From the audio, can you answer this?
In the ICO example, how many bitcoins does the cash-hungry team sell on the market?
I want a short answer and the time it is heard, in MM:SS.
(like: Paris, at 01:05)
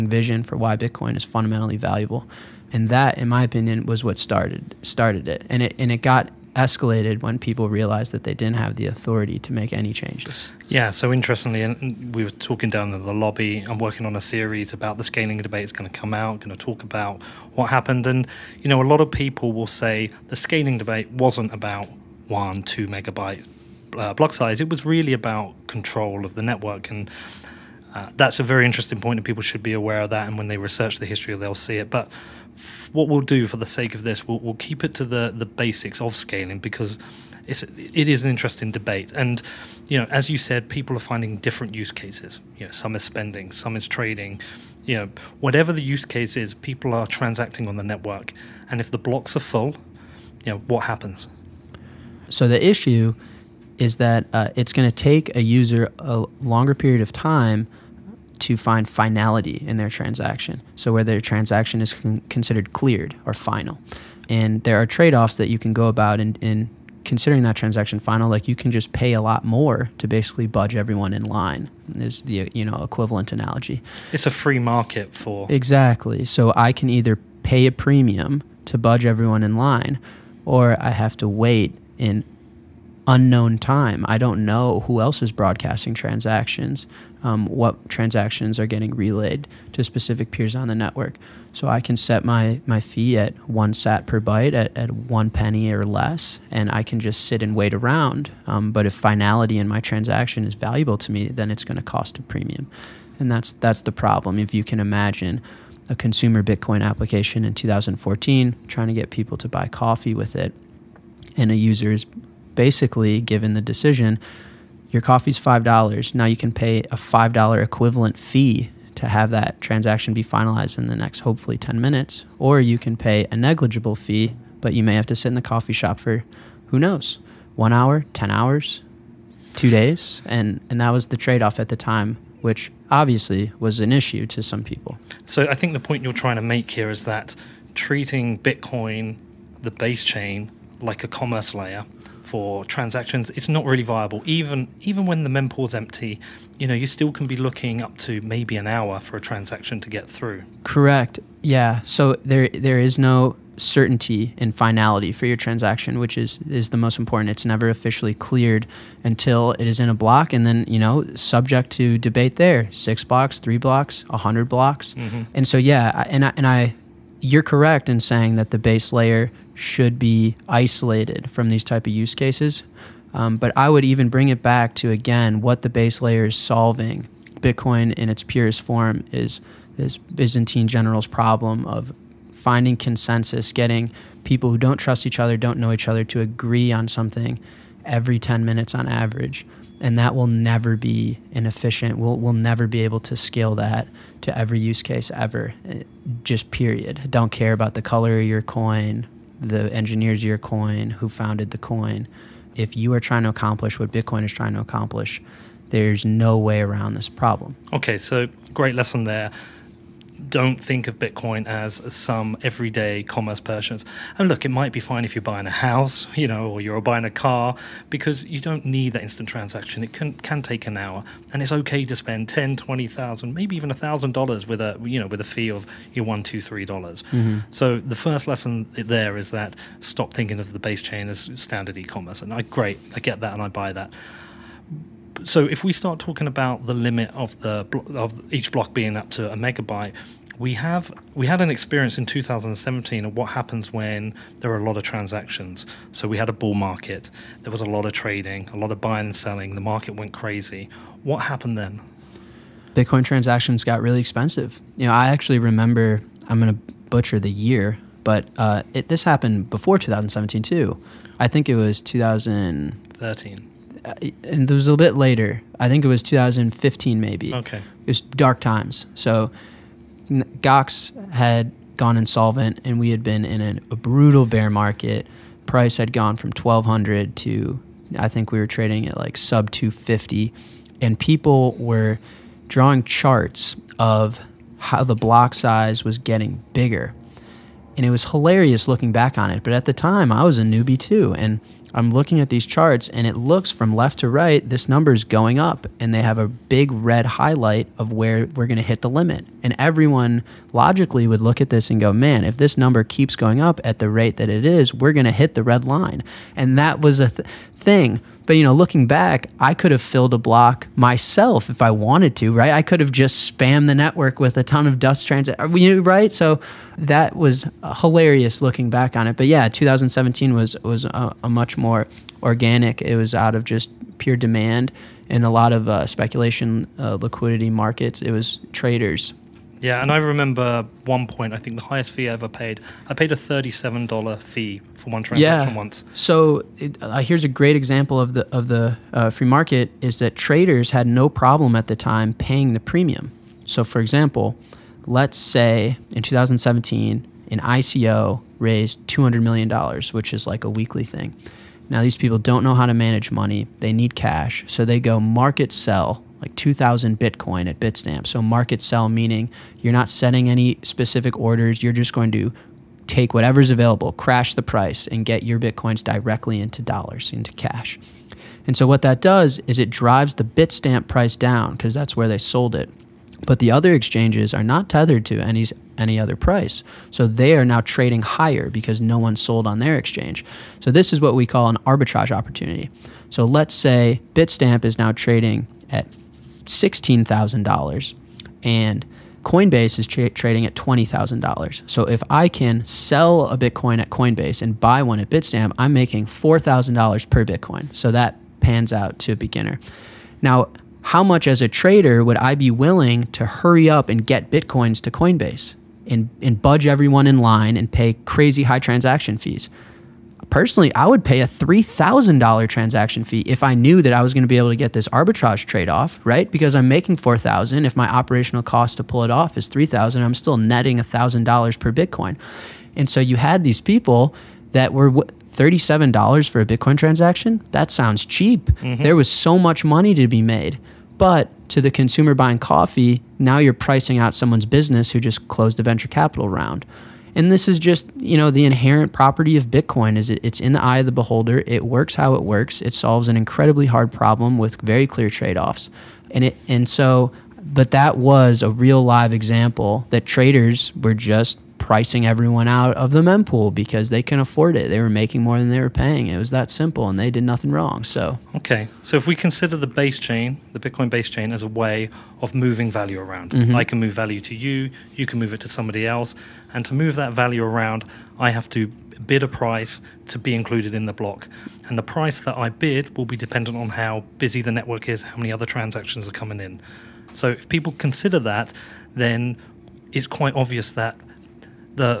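2000, at 05:56.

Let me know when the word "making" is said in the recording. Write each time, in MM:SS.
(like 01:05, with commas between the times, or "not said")
06:35, 06:56, 07:34.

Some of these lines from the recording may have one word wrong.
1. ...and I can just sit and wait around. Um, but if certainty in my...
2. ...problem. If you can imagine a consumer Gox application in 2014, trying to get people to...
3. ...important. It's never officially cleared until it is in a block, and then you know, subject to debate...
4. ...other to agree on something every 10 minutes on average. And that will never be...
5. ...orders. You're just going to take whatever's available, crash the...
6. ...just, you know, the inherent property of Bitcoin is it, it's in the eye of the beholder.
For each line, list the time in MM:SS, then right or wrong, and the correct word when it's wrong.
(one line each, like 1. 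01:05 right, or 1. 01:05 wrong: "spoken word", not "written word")
1. 01:36 wrong: "finality", not "certainty"
2. 01:43 wrong: "Bitcoin", not "Gox"
3. 02:36 right
4. 03:05 right
5. 06:01 right
6. 07:17 right.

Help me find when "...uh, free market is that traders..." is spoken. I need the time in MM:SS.
05:38.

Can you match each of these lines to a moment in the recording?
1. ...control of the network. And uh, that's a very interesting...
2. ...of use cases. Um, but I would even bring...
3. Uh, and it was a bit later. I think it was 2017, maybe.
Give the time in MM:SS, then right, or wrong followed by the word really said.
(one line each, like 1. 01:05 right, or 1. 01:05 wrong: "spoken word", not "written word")
1. 00:25 right
2. 02:51 right
3. 04:23 wrong: "2015", not "2017".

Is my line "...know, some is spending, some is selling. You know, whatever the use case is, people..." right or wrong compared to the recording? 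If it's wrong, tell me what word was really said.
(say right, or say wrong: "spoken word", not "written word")
wrong: "trading", not "selling".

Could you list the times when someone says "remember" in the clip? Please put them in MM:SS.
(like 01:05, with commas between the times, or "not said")
04:15, 05:29.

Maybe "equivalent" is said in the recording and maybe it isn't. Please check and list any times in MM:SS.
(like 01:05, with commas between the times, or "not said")
01:12, 01:57.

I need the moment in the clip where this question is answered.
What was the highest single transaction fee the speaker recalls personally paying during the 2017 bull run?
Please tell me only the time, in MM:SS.
05:33.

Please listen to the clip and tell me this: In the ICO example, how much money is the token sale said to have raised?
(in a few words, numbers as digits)
$200 million.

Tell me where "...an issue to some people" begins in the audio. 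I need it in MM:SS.
02:13.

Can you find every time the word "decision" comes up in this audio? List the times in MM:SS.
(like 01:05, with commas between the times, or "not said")
01:53.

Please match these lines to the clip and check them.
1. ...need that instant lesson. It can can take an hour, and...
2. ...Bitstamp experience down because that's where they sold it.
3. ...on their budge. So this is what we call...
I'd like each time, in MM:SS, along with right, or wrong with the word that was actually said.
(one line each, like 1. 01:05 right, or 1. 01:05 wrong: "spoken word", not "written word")
1. 03:38 wrong: "transaction", not "lesson"
2. 06:10 wrong: "price", not "experience"
3. 06:19 wrong: "exchange", not "budge".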